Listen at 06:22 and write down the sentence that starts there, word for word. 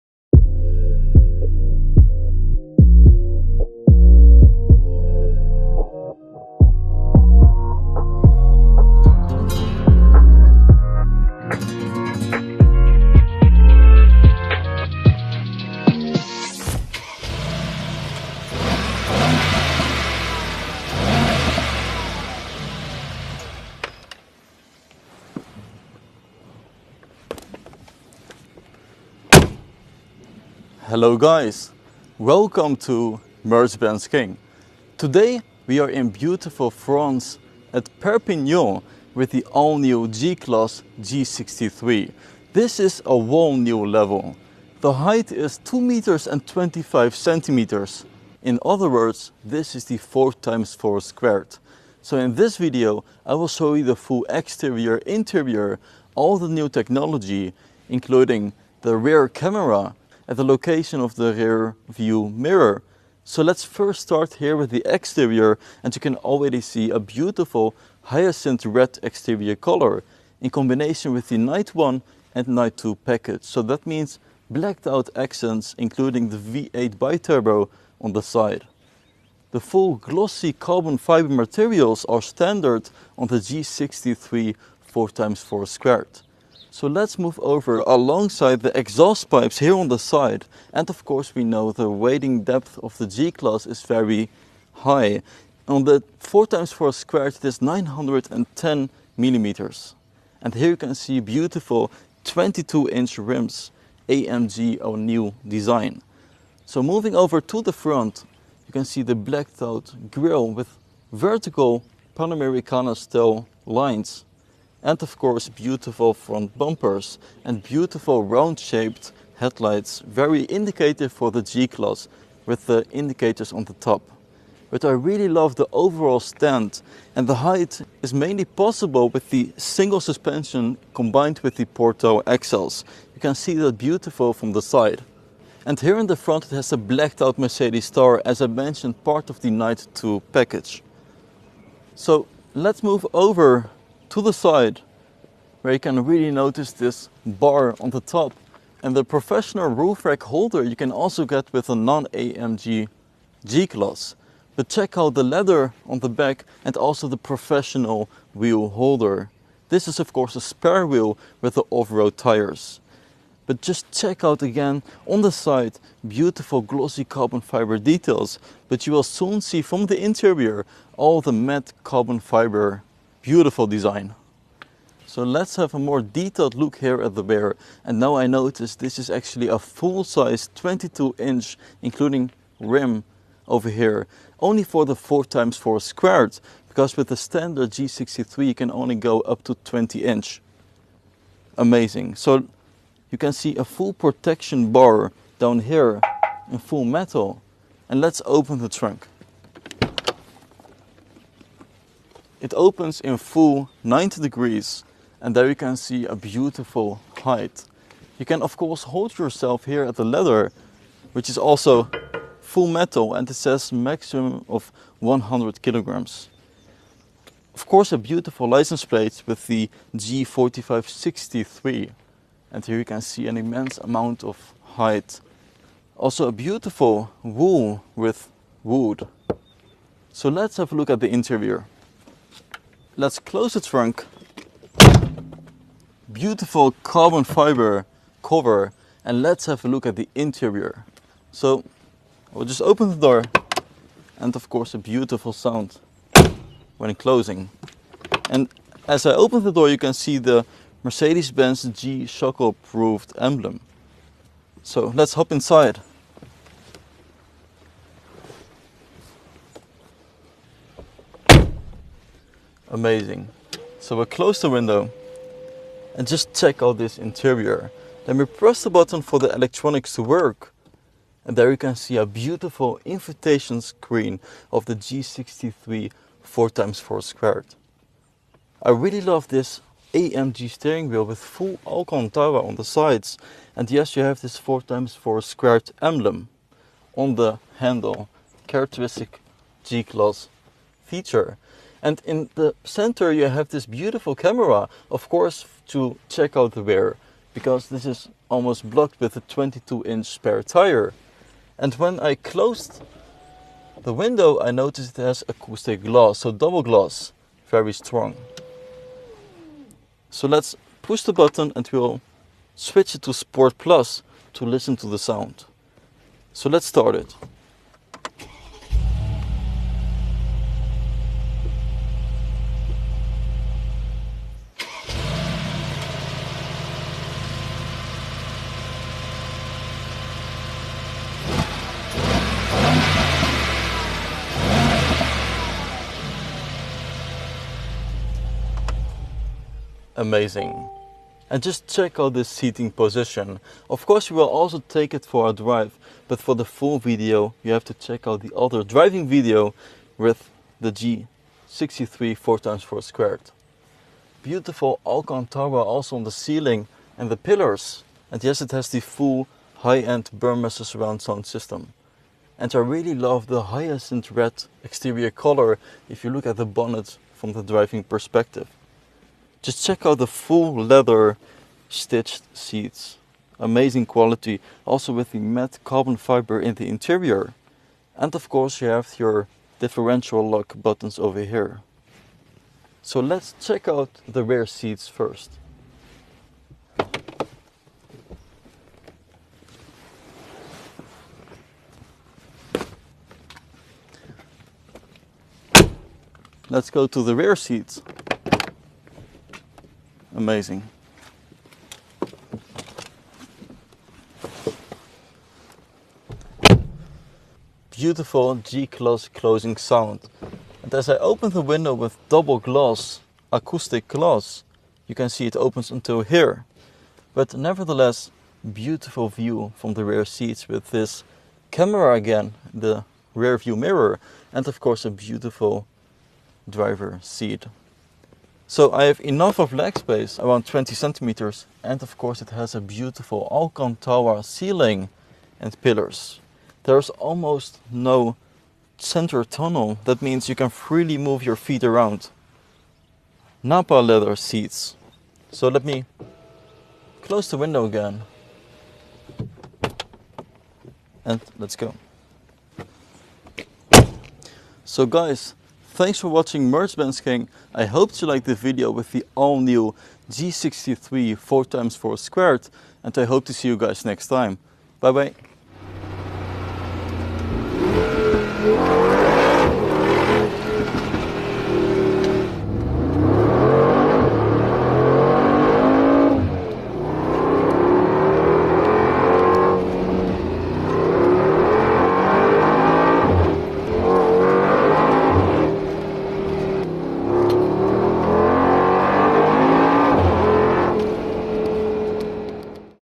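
So let's check out the rear seats first.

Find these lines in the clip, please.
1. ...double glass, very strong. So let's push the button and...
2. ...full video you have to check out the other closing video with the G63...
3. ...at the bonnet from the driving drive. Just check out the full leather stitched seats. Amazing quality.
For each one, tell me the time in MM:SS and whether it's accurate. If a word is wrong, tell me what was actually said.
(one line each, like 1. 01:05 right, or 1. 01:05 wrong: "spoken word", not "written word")
1. 05:06 right
2. 05:46 wrong: "driving", not "closing"
3. 06:06 wrong: "perspective", not "drive".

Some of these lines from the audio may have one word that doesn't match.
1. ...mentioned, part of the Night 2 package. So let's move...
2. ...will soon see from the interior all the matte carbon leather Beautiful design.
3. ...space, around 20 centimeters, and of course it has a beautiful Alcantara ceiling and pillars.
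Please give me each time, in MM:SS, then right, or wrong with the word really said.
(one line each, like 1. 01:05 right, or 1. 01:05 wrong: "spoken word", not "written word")
1. 02:18 right
2. 02:48 wrong: "fiber", not "leather"
3. 07:09 right.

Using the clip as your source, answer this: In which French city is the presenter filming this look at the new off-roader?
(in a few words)
Perpignan.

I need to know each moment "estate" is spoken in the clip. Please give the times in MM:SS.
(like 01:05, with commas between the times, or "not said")
not said.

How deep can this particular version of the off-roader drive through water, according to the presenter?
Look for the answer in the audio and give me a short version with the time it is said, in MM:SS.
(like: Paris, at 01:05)
910 millimeters, at 01:37.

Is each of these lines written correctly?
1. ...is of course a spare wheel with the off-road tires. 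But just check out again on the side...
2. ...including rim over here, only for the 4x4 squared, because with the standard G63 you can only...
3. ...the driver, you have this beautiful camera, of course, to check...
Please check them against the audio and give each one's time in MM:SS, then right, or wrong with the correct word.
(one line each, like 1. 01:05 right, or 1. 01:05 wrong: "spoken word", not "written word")
1. 02:39 right
2. 03:01 right
3. 04:52 wrong: "center", not "driver".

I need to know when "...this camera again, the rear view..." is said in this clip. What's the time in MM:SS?
07:00.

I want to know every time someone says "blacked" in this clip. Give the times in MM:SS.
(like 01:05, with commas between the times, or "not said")
01:14, 01:49, 02:16.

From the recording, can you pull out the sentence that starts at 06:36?
Let's go to the rear seats amazing.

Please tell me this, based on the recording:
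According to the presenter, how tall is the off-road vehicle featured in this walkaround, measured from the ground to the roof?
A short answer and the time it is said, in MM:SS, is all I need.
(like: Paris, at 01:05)
2 meters and 25 centimeters, at 00:45.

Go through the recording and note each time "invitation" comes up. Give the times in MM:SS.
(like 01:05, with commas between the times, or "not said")
04:32.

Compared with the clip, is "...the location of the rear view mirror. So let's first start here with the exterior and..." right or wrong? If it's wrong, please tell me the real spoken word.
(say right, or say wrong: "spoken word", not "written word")
right.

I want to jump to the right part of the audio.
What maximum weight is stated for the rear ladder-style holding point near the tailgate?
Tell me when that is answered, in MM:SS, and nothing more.
03:34.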